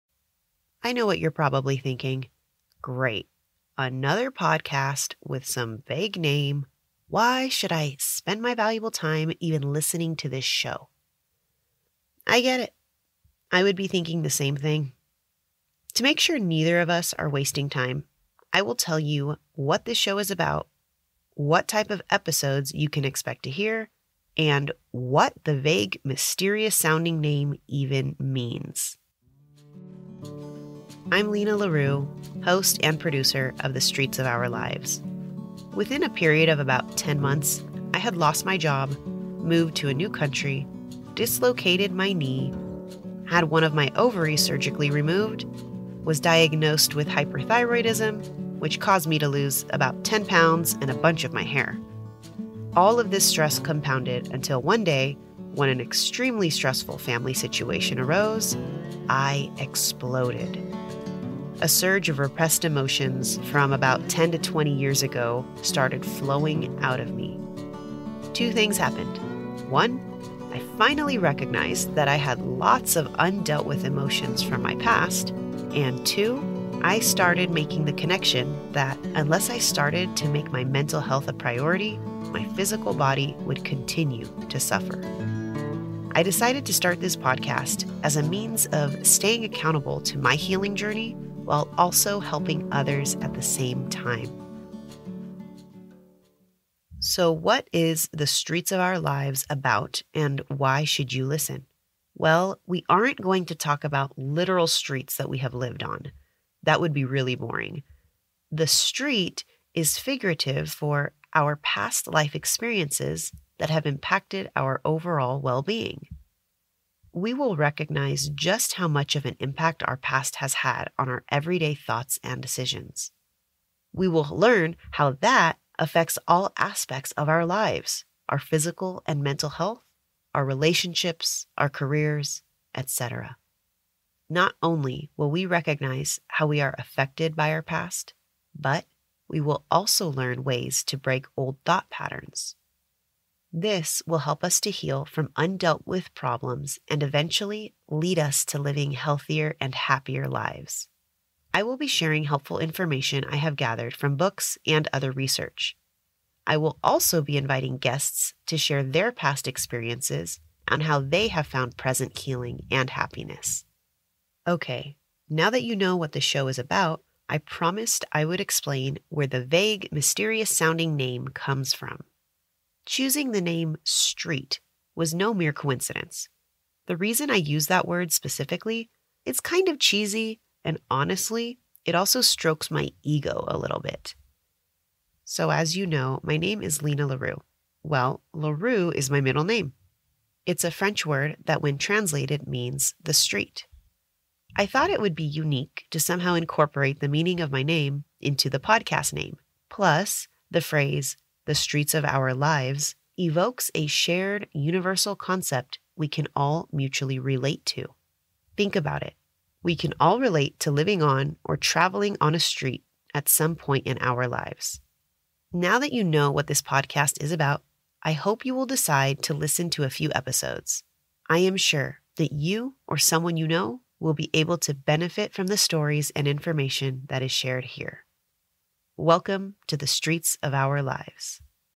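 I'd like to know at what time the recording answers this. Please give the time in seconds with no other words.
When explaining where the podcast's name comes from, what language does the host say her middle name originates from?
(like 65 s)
190 s.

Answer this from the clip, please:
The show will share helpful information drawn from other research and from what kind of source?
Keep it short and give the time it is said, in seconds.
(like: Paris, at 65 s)
books, at 154 s.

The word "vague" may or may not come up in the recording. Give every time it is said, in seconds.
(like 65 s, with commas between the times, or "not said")
5 s, 25 s, 169 s.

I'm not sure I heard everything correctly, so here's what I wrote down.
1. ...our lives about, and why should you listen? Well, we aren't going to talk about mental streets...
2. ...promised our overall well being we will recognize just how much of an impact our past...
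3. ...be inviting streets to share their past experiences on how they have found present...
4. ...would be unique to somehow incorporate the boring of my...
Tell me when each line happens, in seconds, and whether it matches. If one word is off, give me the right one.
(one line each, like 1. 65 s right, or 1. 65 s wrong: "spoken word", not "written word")
1. 98 s wrong: "literal", not "mental"
2. 113 s wrong: "impacted", not "promised"
3. 157 s wrong: "guests", not "streets"
4. 194 s wrong: "meaning", not "boring".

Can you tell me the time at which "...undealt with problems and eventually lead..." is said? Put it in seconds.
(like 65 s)
145 s.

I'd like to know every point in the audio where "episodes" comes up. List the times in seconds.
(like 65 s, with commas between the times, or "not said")
22 s, 220 s.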